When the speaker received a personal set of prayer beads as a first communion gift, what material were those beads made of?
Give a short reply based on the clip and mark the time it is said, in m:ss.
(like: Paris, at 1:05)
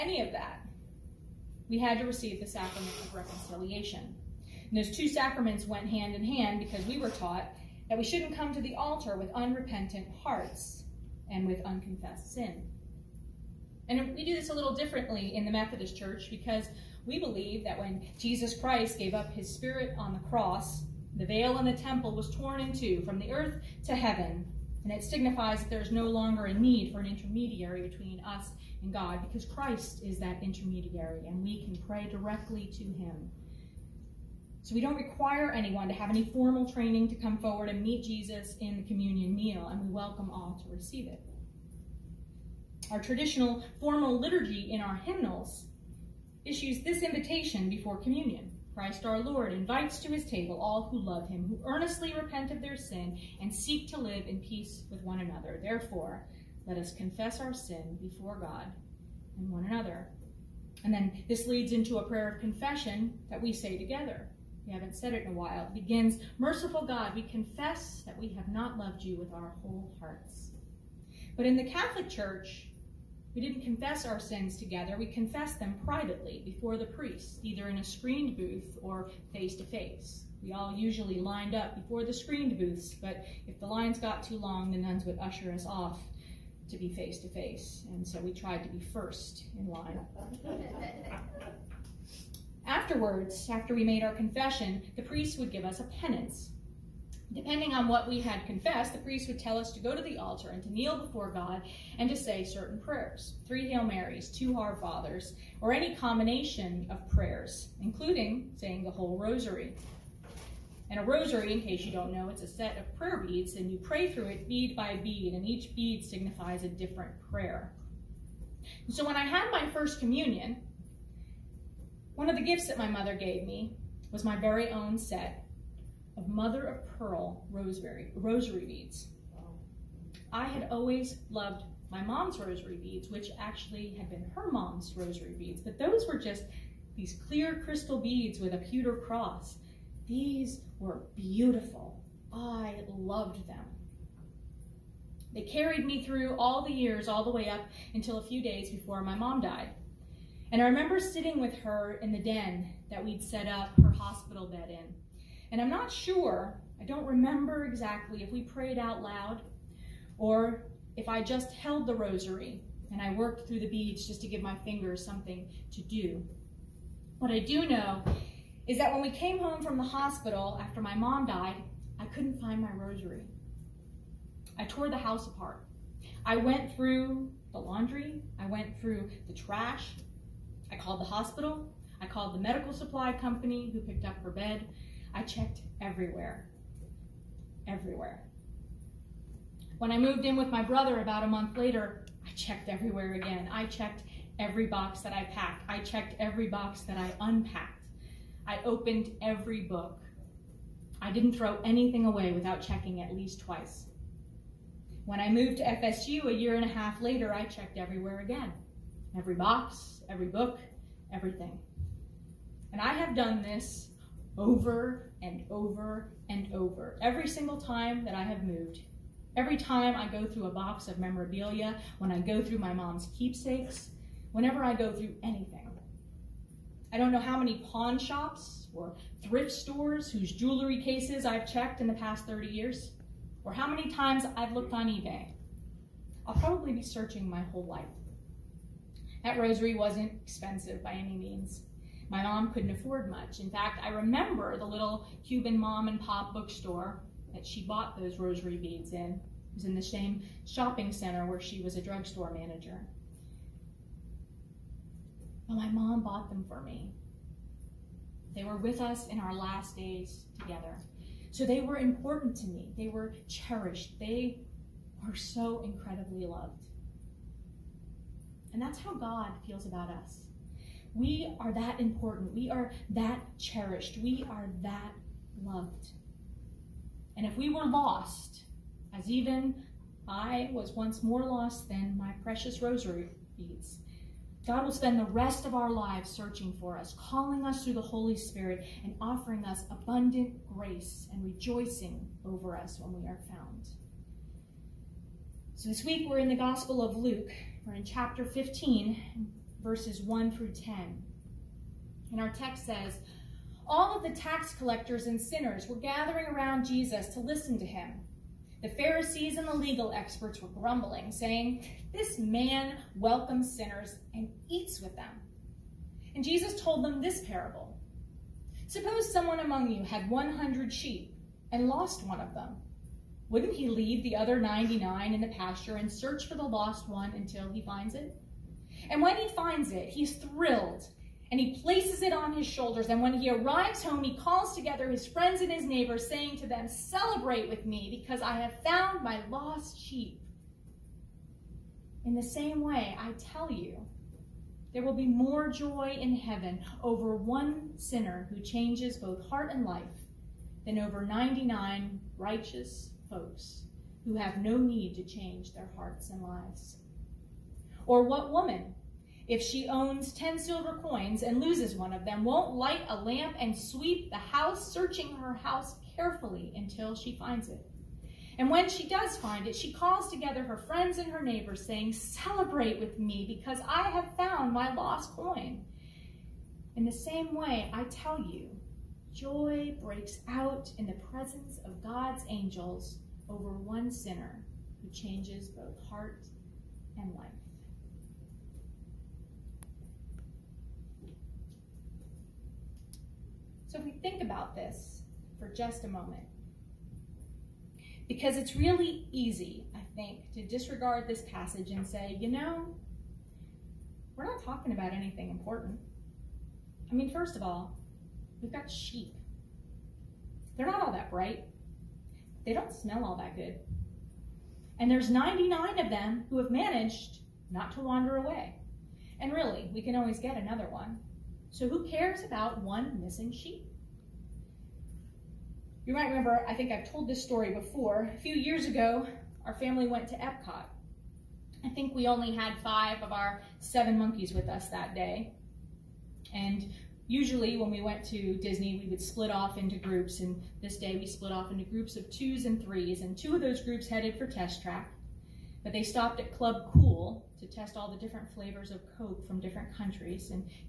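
Mother of pearl, at 2:06.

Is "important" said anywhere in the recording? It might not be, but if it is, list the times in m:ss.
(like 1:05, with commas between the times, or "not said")
4:21, 4:31, 6:45.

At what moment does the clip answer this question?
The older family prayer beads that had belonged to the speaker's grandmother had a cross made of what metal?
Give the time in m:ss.
2:18.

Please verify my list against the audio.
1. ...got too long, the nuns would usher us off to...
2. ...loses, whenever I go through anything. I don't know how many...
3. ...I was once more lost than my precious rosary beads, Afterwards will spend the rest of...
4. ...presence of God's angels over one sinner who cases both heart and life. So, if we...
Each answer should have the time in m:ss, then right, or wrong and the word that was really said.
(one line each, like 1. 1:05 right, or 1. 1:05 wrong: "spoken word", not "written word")
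1. 1:23 right
2. 3:43 wrong: "keepsakes", not "loses"
3. 4:40 wrong: "God", not "Afterwards"
4. 6:21 wrong: "changes", not "cases".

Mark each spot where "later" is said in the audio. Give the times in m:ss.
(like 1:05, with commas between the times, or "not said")
3:11, 3:27.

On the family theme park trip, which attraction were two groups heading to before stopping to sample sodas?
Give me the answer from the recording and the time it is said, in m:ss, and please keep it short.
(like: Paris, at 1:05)
Test Track, at 7:24.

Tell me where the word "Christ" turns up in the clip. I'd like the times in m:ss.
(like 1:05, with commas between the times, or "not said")
0:18, 0:29, 0:48.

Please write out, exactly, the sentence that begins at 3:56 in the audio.
I'll probably be searching my whole life.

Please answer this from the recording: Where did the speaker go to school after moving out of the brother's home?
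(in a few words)
FSU.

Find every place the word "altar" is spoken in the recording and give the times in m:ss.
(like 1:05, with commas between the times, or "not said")
0:08, 1:40.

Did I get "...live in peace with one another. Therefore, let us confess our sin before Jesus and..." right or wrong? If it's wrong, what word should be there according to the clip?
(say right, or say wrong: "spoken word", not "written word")
wrong: "God", not "Jesus".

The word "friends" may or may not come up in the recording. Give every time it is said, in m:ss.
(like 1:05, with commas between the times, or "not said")
5:35, 6:10.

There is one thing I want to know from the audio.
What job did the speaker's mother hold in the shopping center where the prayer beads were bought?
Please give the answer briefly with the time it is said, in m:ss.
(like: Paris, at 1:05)
Drugstore manager, at 4:11.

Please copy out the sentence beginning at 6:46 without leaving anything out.
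I mean, first of all, We've got sheep.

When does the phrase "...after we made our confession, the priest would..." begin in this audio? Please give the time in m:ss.
1:33.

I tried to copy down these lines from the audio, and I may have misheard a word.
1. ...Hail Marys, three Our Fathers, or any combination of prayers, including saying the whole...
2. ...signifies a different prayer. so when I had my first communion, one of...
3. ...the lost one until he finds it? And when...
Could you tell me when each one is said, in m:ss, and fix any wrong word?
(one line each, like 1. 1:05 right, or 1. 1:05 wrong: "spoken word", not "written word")
1. 1:43 wrong: "two", not "three"
2. 1:56 right
3. 5:26 right.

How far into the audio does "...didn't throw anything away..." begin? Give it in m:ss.
3:21.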